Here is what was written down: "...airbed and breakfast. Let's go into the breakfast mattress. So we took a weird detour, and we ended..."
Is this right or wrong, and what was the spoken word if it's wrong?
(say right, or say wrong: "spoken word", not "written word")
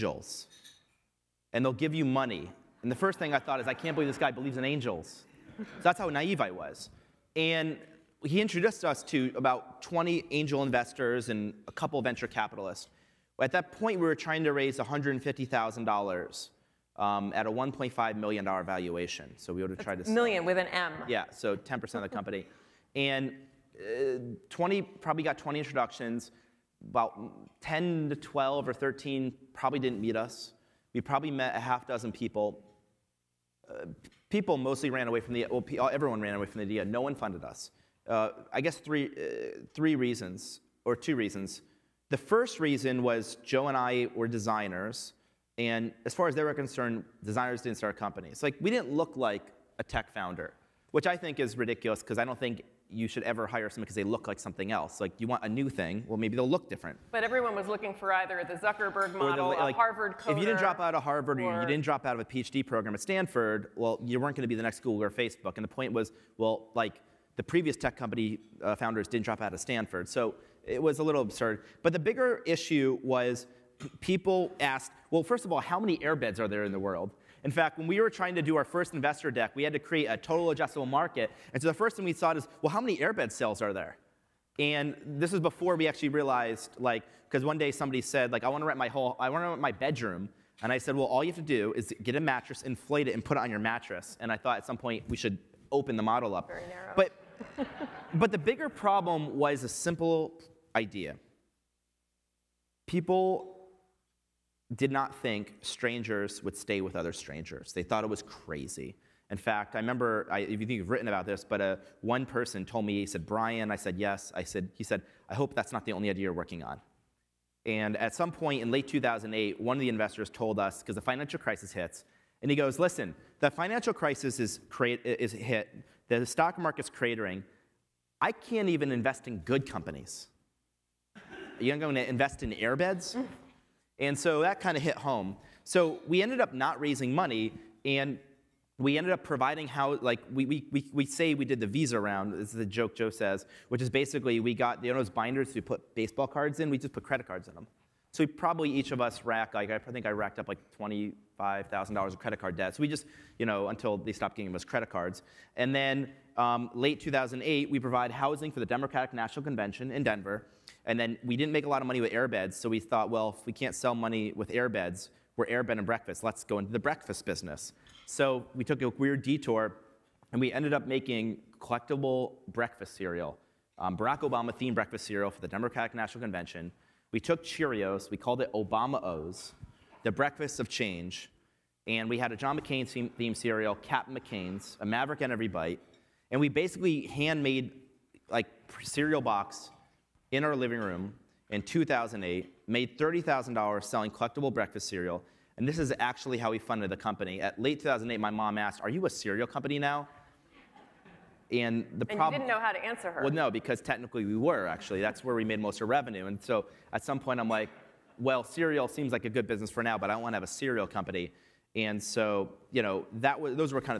wrong: "business", not "mattress".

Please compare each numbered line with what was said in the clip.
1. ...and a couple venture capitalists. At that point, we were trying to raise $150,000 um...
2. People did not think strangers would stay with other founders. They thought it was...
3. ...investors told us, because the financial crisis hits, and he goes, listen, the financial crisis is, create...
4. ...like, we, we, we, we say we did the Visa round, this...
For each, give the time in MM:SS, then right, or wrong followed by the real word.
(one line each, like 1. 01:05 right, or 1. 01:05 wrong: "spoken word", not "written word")
1. 00:11 right
2. 01:42 wrong: "strangers", not "founders"
3. 01:59 right
4. 02:20 right.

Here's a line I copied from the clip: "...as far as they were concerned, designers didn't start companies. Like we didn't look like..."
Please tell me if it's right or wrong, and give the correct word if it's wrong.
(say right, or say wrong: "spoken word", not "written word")
right.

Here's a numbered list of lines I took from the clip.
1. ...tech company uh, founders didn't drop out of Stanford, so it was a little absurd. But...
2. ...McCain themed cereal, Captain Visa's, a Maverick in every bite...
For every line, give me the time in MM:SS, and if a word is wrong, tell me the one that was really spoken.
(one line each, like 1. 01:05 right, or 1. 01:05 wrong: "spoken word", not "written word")
1. 01:07 right
2. 03:02 wrong: "McCain", not "Visa".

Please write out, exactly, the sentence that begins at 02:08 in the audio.
I can't even invest in good companies.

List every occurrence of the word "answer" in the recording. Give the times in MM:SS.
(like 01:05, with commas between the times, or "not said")
03:22.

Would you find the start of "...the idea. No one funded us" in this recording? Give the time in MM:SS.
00:36.